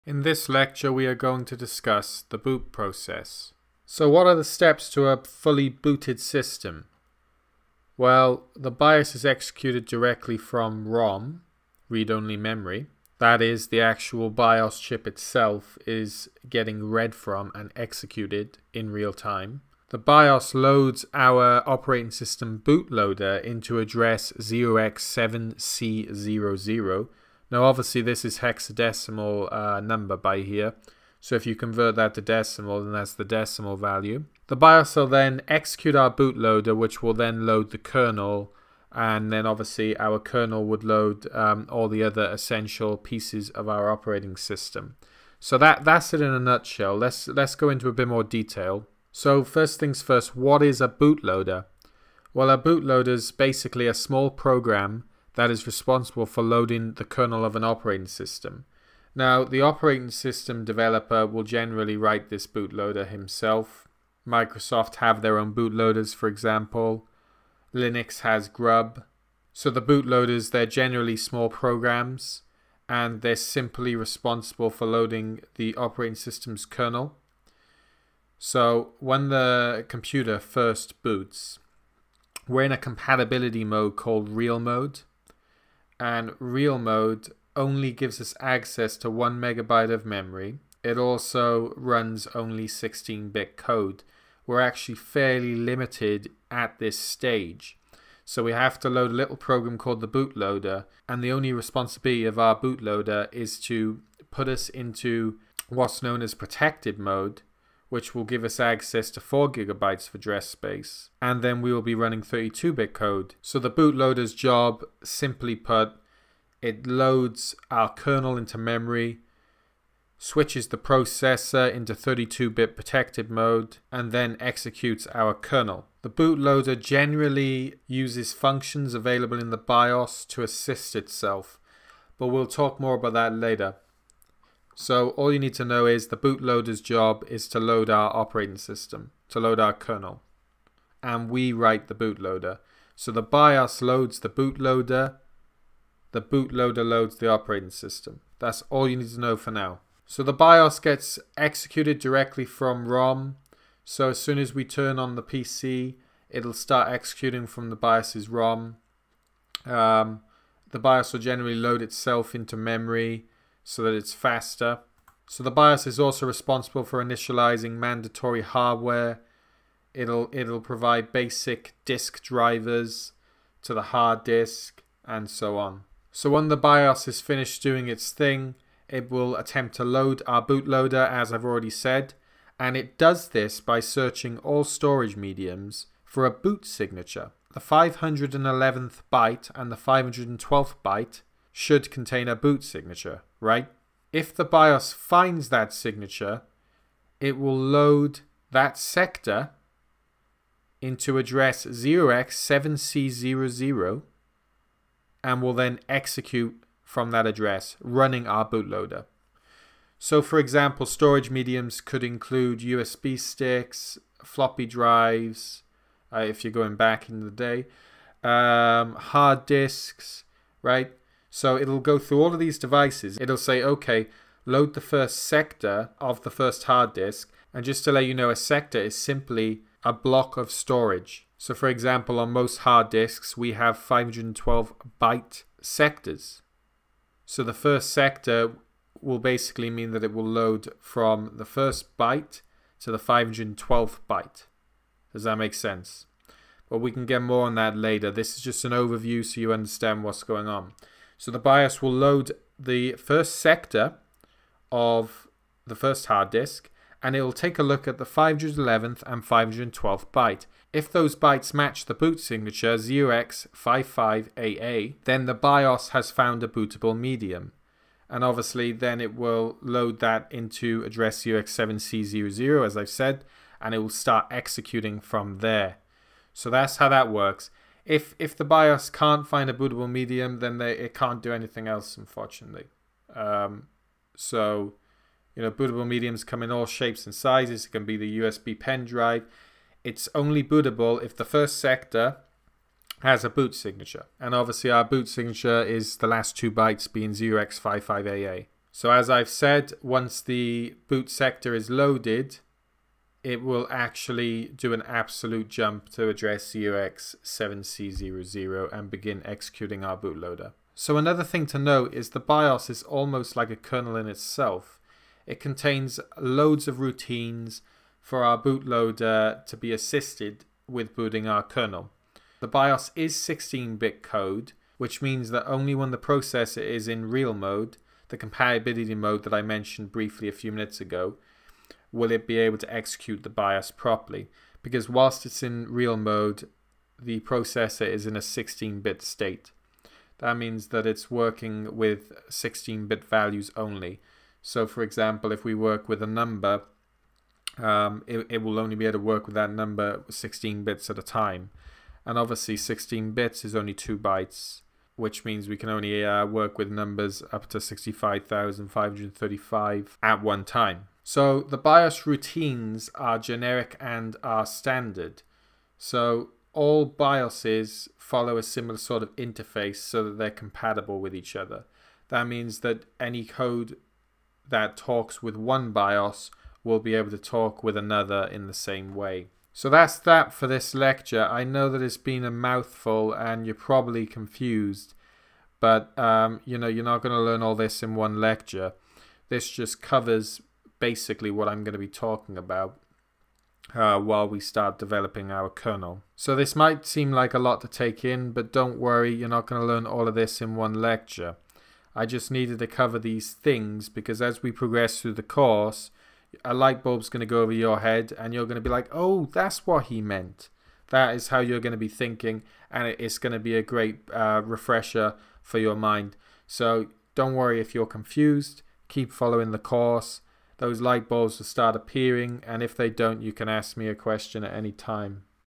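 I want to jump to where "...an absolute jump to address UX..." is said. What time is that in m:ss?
5:04.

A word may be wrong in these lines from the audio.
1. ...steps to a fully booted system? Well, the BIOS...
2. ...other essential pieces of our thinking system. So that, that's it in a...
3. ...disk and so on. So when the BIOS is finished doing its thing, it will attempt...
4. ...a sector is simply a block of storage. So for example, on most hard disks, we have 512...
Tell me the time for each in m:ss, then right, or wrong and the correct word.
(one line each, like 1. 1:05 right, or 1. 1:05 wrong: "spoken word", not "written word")
1. 0:04 right
2. 0:42 wrong: "operating", not "thinking"
3. 2:54 right
4. 3:48 right.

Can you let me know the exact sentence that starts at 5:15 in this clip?
It contains loads of routines for our bootloader to be assisted with booting our kernel.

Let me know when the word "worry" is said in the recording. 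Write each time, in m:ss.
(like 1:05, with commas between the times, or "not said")
6:38, 6:57.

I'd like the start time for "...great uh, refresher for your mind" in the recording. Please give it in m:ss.
6:53.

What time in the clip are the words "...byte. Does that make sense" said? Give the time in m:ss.
4:04.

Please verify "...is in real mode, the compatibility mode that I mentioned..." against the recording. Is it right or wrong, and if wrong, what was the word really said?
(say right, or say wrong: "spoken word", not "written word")
right.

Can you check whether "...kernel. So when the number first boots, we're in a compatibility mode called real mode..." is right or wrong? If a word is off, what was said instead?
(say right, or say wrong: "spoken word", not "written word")
wrong: "computer", not "number".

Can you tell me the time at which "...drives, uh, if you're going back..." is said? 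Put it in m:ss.
3:34.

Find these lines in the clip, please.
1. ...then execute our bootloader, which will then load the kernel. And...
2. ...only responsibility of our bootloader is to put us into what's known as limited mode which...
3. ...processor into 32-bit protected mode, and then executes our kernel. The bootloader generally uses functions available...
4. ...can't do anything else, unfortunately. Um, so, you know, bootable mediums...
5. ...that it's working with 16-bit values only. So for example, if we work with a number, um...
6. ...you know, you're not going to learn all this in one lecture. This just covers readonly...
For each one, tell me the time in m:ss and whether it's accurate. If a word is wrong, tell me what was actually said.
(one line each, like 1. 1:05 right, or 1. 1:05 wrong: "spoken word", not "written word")
1. 0:35 right
2. 1:41 wrong: "protected", not "limited"
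3. 2:00 right
4. 4:40 right
5. 5:40 right
6. 6:26 wrong: "basically", not "readonly".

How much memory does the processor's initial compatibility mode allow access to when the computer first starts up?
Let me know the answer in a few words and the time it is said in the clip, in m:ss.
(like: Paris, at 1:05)
1 megabyte, at 1:29.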